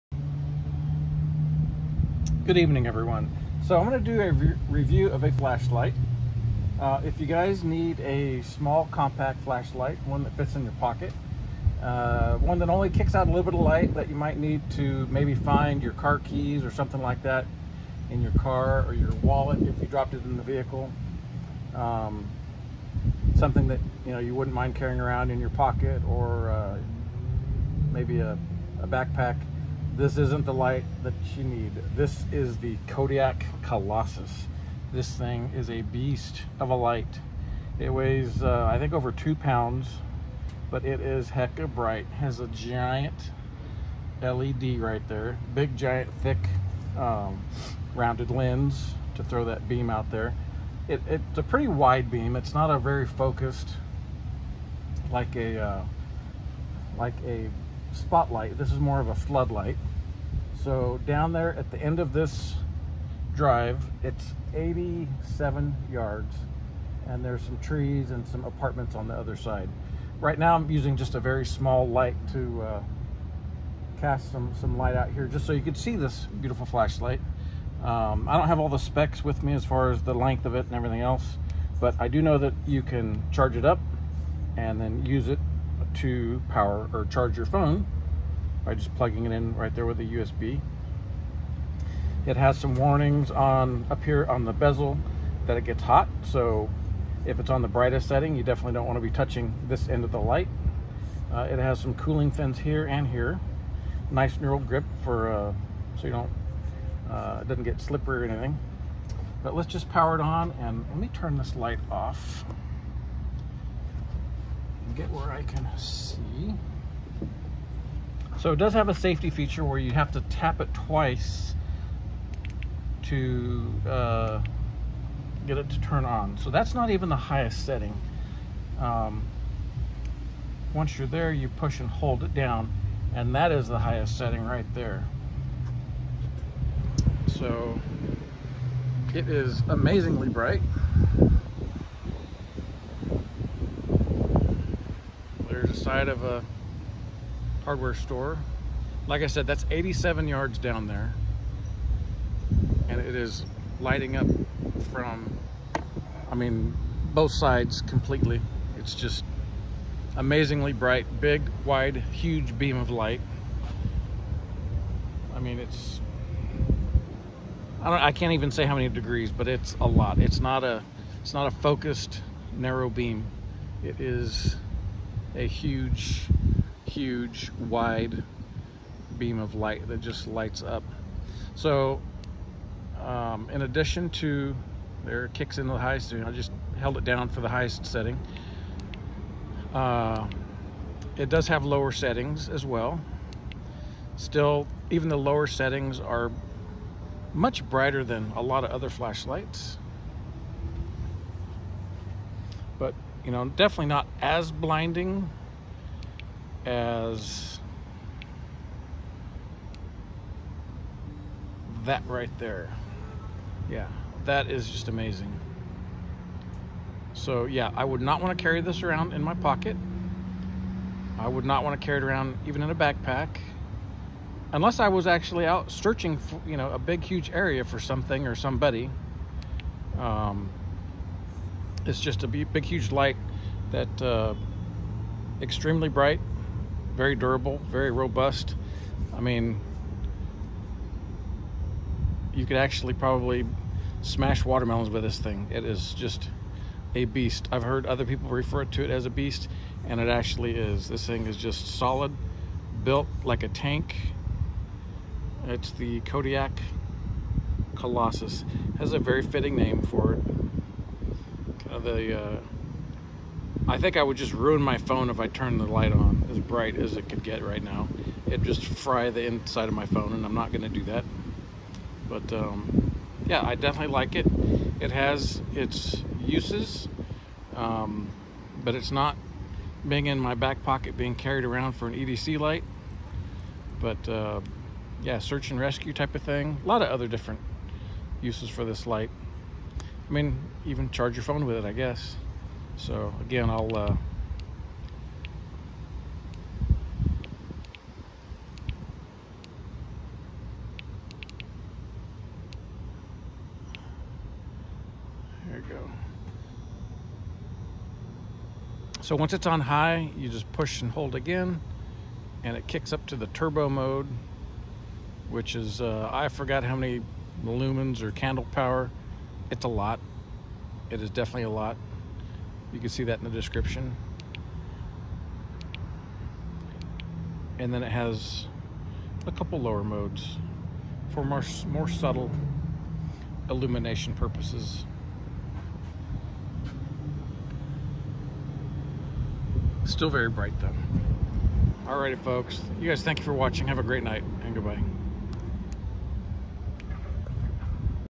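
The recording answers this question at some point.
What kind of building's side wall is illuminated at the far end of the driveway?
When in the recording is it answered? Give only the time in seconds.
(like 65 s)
147 s.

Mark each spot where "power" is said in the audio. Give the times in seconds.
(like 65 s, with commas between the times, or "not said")
86 s, 109 s, 318 s.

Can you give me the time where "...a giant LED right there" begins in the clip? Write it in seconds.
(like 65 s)
42 s.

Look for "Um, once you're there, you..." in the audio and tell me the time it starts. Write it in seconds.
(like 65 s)
128 s.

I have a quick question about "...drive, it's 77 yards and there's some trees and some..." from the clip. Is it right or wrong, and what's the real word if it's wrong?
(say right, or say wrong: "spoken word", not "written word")
wrong: "87", not "77".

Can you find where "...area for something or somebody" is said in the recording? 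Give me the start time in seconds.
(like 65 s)
227 s.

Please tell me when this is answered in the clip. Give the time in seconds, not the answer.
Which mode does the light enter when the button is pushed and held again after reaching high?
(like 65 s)
313 s.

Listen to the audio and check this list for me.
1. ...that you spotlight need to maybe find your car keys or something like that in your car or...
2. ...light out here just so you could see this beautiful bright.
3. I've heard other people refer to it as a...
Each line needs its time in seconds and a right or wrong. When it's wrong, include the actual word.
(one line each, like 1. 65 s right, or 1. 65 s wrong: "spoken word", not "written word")
1. 13 s wrong: "might", not "spotlight"
2. 74 s wrong: "flashlight", not "bright"
3. 247 s right.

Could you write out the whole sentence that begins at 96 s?
So if it's on the brightest setting, you definitely don't want to be touching this end of the light.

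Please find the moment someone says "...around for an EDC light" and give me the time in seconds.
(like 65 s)
281 s.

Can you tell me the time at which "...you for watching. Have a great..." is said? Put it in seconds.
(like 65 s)
343 s.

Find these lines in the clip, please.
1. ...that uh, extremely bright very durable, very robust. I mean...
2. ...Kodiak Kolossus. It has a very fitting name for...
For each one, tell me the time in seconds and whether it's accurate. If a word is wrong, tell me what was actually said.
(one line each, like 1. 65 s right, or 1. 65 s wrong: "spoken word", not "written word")
1. 233 s right
2. 256 s right.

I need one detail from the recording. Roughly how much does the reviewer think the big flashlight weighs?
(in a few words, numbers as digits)
over 2 pounds.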